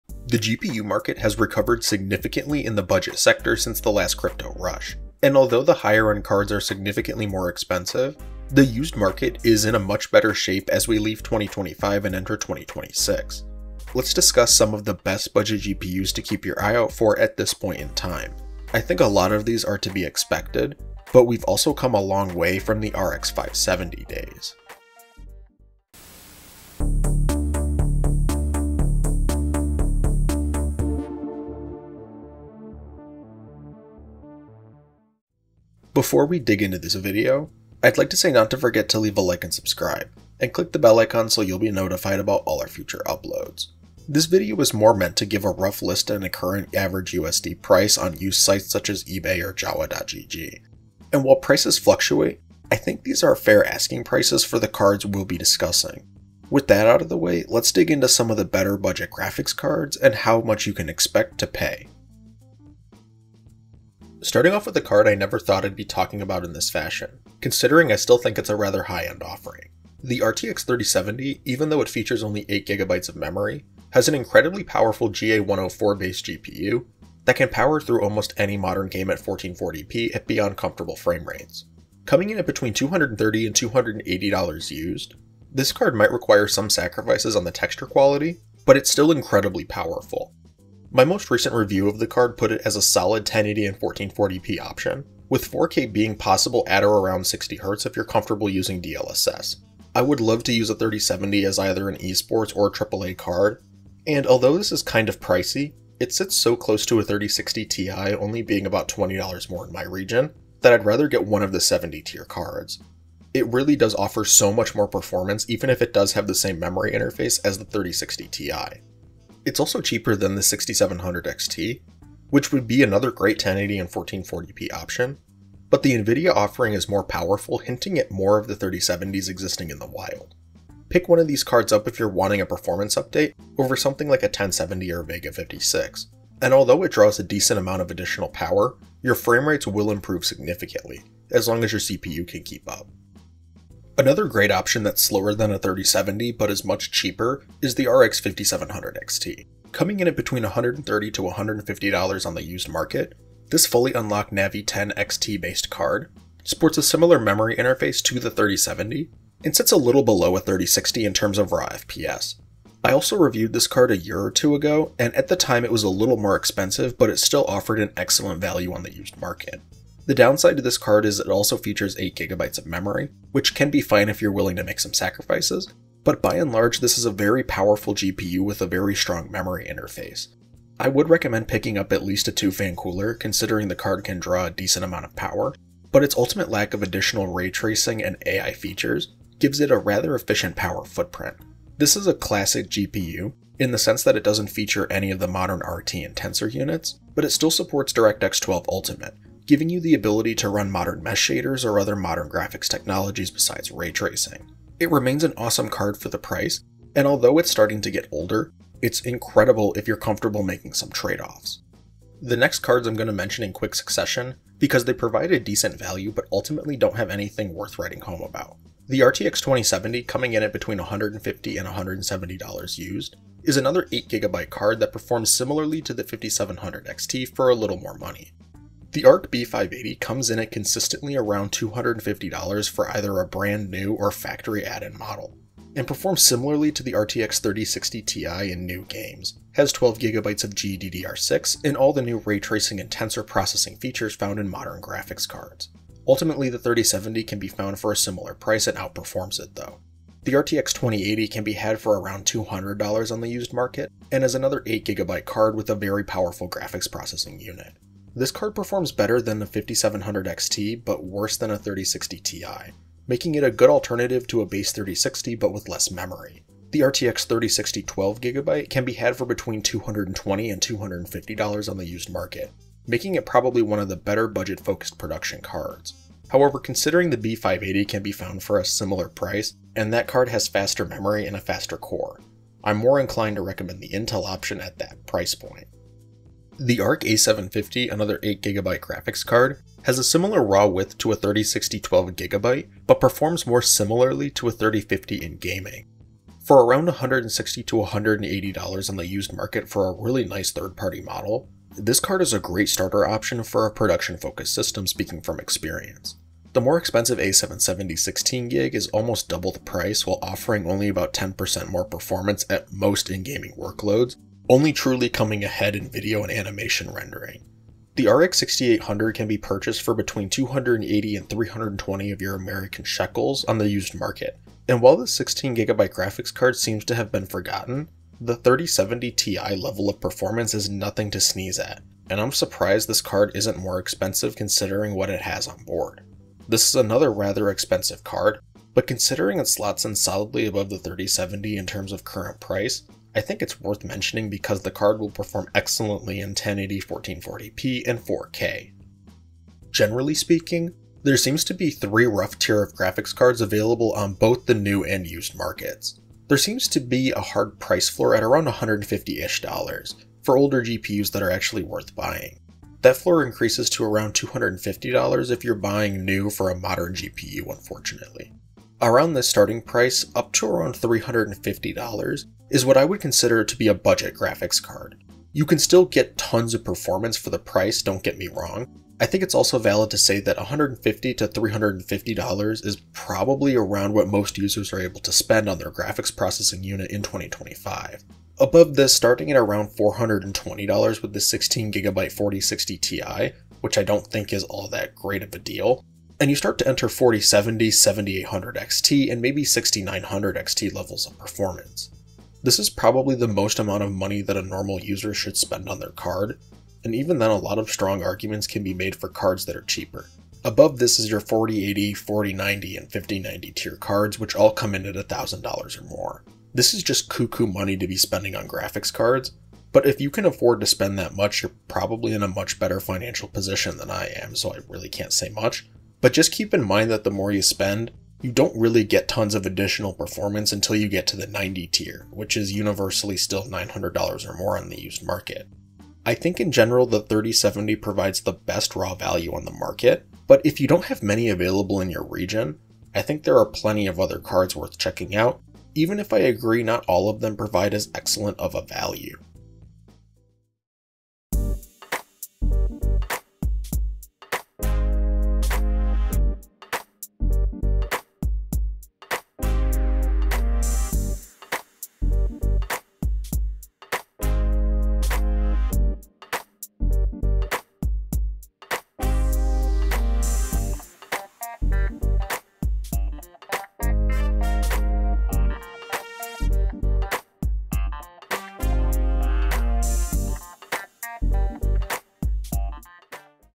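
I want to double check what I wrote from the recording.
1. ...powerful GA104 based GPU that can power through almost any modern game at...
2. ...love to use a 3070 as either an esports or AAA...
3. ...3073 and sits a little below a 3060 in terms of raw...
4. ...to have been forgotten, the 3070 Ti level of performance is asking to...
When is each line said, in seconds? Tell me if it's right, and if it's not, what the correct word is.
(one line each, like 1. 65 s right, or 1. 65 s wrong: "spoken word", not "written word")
1. 74 s right
2. 100 s right
3. 158 s wrong: "3070", not "3073"
4. 326 s wrong: "nothing", not "asking".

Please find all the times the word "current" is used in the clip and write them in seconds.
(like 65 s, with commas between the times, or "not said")
46 s, 342 s.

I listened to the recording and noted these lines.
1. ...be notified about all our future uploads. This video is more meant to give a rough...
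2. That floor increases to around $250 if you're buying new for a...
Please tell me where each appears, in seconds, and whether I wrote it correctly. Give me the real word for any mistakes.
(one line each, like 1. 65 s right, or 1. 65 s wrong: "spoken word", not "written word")
1. 41 s right
2. 362 s right.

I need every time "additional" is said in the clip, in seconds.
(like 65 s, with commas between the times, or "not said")
137 s, 186 s, 429 s.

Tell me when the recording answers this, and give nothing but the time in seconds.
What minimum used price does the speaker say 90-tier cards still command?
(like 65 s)
433 s.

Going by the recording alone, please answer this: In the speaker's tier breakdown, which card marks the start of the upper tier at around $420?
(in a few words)
16GB 4060 Ti.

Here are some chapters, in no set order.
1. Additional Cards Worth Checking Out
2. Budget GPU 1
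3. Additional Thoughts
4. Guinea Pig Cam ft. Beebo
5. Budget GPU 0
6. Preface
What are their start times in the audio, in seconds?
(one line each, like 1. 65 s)
1. 211 s
2. 143 s
3. 349 s
4. 450 s
5. 63 s
6. 35 s.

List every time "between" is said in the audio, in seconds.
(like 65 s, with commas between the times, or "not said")
82 s, 150 s, 220 s, 269 s, 319 s.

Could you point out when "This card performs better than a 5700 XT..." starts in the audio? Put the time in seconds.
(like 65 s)
258 s.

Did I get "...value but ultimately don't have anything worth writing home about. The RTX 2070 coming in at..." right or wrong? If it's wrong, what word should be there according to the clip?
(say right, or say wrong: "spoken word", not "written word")
right.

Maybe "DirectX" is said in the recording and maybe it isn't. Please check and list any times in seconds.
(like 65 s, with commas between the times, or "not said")
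197 s.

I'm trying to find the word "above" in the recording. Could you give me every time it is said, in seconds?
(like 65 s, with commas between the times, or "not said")
340 s, 388 s, 410 s.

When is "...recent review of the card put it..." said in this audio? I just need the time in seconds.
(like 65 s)
91 s.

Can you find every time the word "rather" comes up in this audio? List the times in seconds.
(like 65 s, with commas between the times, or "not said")
68 s, 110 s, 189 s, 337 s.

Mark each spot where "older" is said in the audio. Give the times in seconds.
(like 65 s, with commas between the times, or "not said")
208 s, 360 s.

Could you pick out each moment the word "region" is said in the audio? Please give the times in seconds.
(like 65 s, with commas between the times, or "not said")
109 s, 442 s.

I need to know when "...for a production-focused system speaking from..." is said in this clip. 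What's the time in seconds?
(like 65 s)
303 s.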